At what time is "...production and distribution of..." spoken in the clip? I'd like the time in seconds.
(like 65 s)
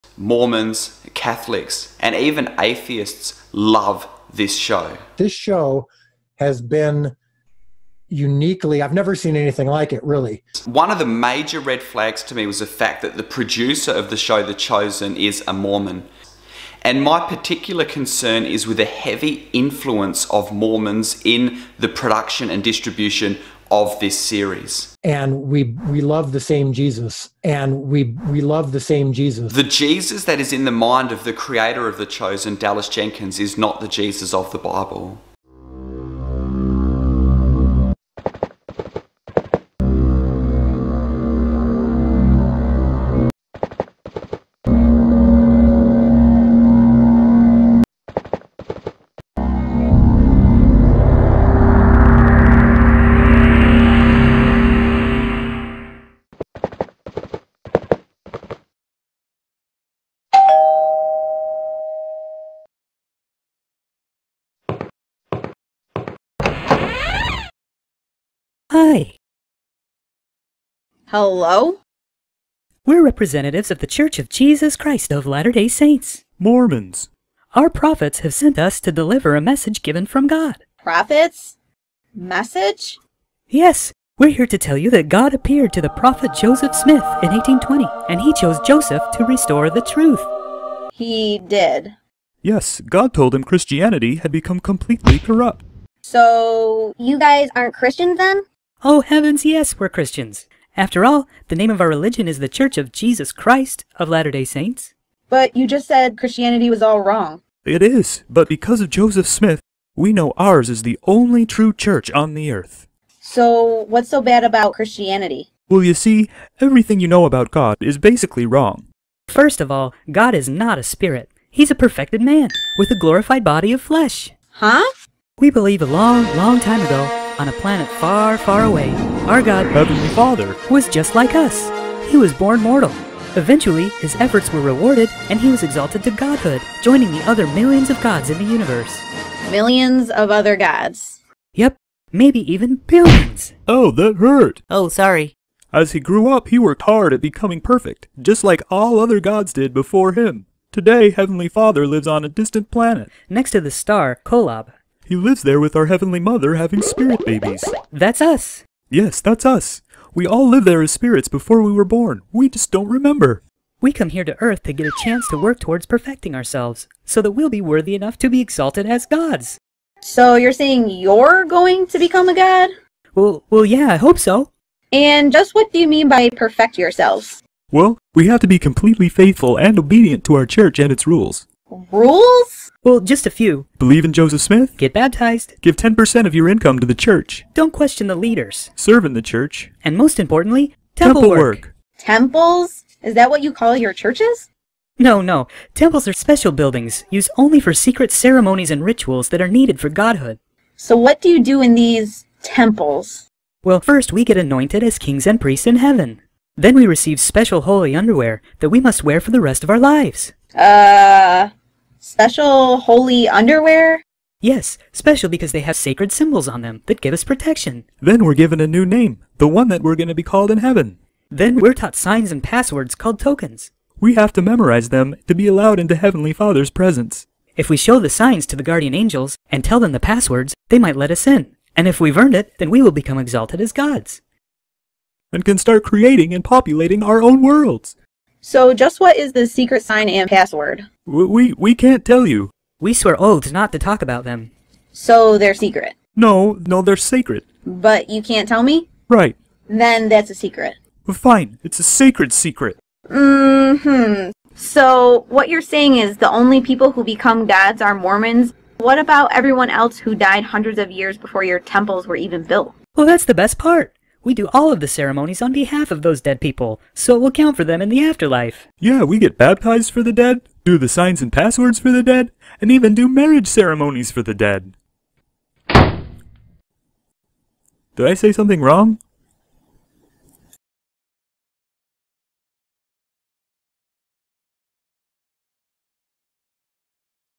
21 s.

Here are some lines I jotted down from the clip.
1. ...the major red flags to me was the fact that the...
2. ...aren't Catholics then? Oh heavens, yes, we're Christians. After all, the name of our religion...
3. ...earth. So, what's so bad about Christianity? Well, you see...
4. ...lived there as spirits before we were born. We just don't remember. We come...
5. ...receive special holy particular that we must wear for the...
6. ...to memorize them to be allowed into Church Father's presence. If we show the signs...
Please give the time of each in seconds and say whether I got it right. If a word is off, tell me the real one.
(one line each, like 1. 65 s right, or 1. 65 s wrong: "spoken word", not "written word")
1. 10 s right
2. 97 s wrong: "Christians", not "Catholics"
3. 112 s right
4. 160 s right
5. 206 s wrong: "underwear", not "particular"
6. 224 s wrong: "Heavenly", not "Church".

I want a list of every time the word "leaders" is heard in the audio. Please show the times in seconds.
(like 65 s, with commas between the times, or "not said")
188 s.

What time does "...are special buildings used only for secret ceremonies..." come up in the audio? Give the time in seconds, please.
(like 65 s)
196 s.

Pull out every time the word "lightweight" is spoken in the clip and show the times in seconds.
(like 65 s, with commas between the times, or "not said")
not said.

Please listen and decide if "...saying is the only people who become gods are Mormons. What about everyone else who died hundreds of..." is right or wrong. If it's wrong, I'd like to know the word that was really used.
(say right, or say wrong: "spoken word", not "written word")
right.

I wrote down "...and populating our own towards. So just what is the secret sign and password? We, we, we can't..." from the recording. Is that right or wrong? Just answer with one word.
wrong.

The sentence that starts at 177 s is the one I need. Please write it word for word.
Well, we have to be completely faithful and obedient to our church and its rules.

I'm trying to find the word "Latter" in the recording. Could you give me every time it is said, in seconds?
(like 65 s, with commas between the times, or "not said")
75 s, 104 s.